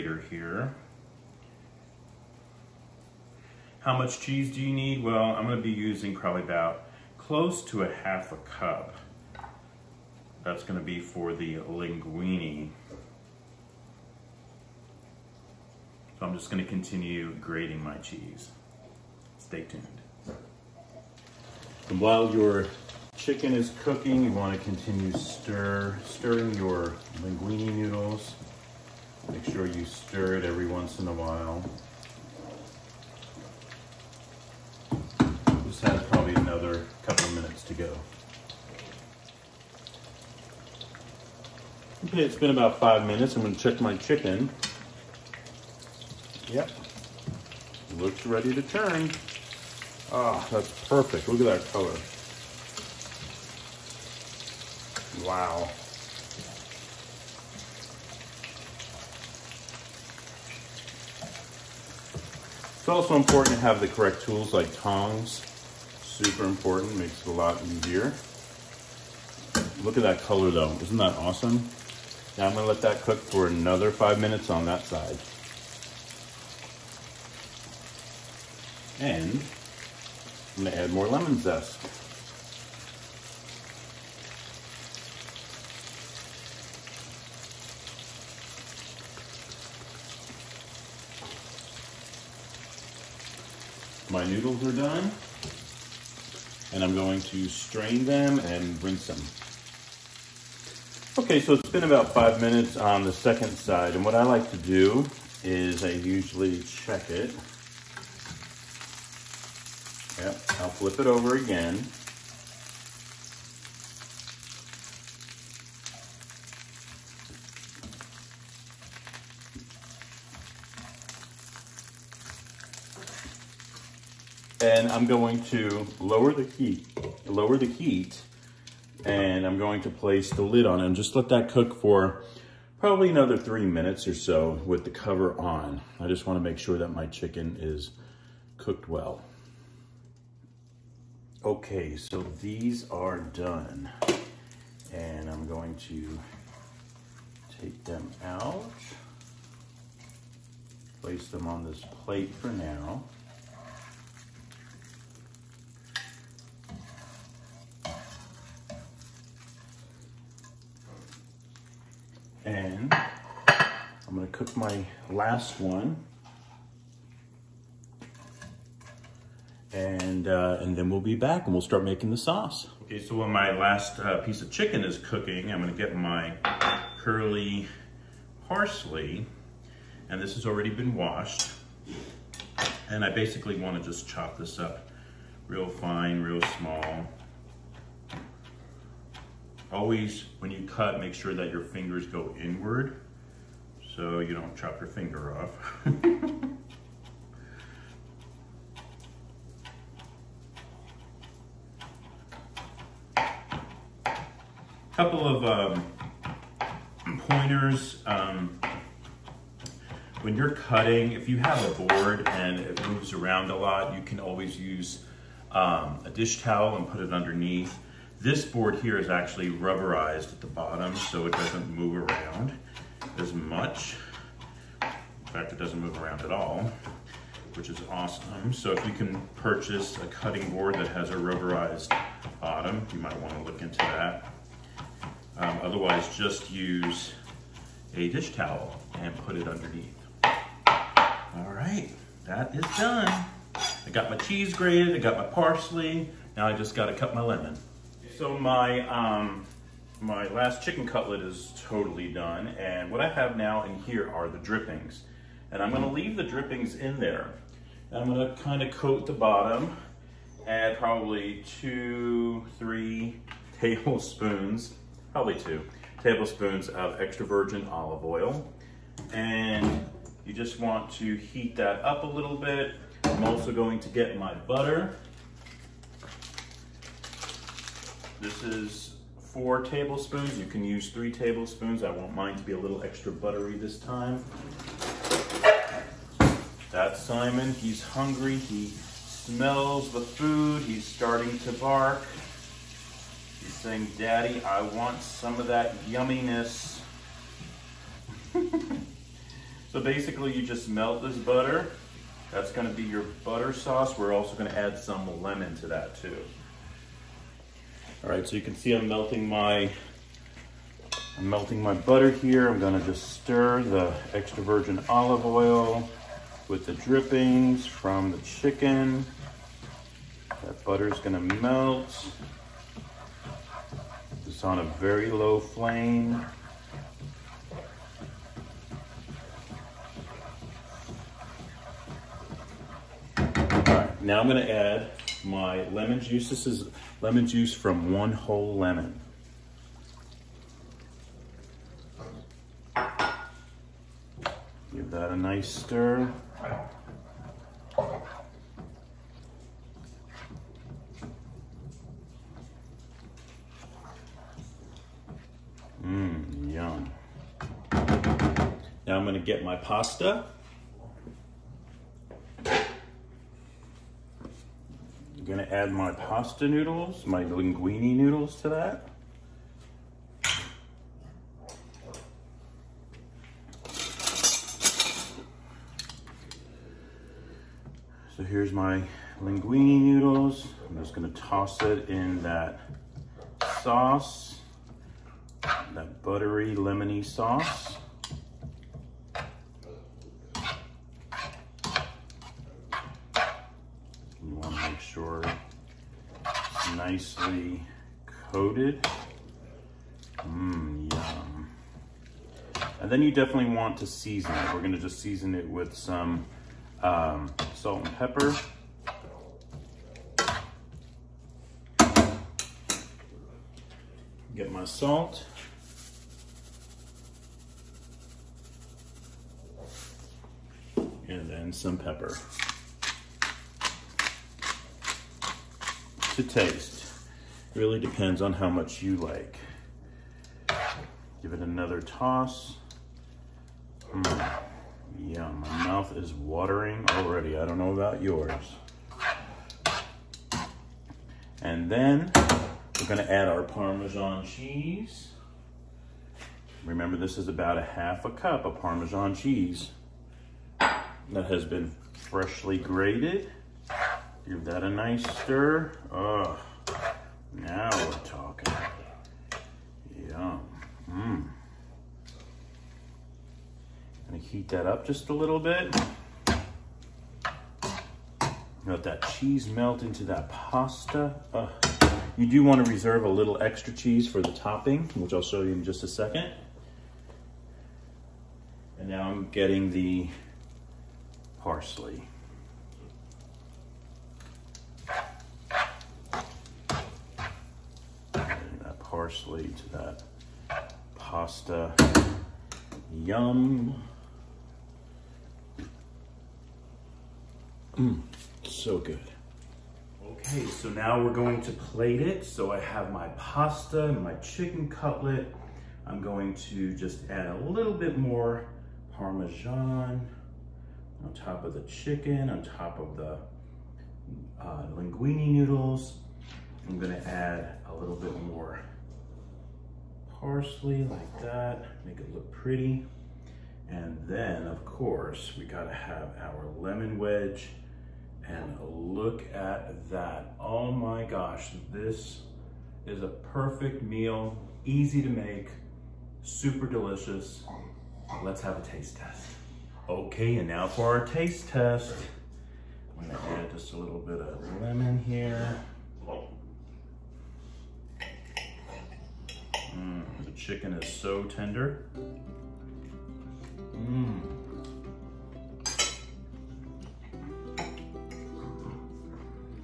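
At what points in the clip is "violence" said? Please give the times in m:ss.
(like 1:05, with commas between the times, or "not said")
not said.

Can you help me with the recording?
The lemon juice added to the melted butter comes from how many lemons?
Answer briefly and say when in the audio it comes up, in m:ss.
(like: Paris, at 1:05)
1 whole lemon, at 5:37.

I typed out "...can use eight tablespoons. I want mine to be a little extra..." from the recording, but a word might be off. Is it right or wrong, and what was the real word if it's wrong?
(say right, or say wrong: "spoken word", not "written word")
wrong: "three", not "eight".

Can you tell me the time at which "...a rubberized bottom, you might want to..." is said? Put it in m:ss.
3:51.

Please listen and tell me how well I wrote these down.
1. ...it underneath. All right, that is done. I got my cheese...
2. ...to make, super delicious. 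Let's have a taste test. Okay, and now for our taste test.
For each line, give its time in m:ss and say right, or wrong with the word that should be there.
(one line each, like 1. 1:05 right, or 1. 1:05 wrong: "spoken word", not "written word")
1. 3:59 right
2. 8:55 right.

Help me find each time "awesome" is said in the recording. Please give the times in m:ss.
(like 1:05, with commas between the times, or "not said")
1:11, 3:47.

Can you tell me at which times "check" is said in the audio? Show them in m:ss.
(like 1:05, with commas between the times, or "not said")
0:43, 1:46.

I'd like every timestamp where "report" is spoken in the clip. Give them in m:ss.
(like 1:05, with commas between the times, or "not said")
not said.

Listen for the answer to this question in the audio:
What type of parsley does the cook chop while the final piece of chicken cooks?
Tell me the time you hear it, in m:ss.
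2:57.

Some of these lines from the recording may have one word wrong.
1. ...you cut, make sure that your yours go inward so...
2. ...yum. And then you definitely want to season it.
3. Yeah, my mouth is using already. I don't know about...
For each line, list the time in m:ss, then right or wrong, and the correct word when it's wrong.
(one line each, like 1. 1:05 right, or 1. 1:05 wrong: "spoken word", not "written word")
1. 3:10 wrong: "fingers", not "yours"
2. 6:40 right
3. 7:14 wrong: "watering", not "using".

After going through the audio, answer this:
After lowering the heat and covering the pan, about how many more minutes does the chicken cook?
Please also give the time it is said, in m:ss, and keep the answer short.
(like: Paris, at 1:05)
3 minutes, at 2:13.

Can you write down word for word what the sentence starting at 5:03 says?
We're also gonna add some lemon to that too.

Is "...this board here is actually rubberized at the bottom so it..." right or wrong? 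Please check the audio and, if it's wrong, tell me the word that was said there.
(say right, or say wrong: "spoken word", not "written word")
right.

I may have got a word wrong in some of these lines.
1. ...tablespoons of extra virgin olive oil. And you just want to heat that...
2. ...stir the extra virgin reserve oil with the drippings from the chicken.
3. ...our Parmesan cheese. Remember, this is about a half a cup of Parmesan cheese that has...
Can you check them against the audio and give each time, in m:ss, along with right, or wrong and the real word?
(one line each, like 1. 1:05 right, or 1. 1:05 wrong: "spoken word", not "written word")
1. 4:26 right
2. 5:13 wrong: "olive", not "reserve"
3. 7:23 right.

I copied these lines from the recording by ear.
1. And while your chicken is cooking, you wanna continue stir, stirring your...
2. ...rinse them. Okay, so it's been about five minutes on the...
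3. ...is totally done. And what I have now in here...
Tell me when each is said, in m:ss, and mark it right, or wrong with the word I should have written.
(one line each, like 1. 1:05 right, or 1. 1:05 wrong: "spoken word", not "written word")
1. 0:21 right
2. 1:38 right
3. 4:11 right.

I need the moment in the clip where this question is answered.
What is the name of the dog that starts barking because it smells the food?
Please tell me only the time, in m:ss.
4:47.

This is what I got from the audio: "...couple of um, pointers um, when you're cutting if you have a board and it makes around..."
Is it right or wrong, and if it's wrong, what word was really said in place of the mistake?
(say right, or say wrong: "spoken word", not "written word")
wrong: "moves", not "makes".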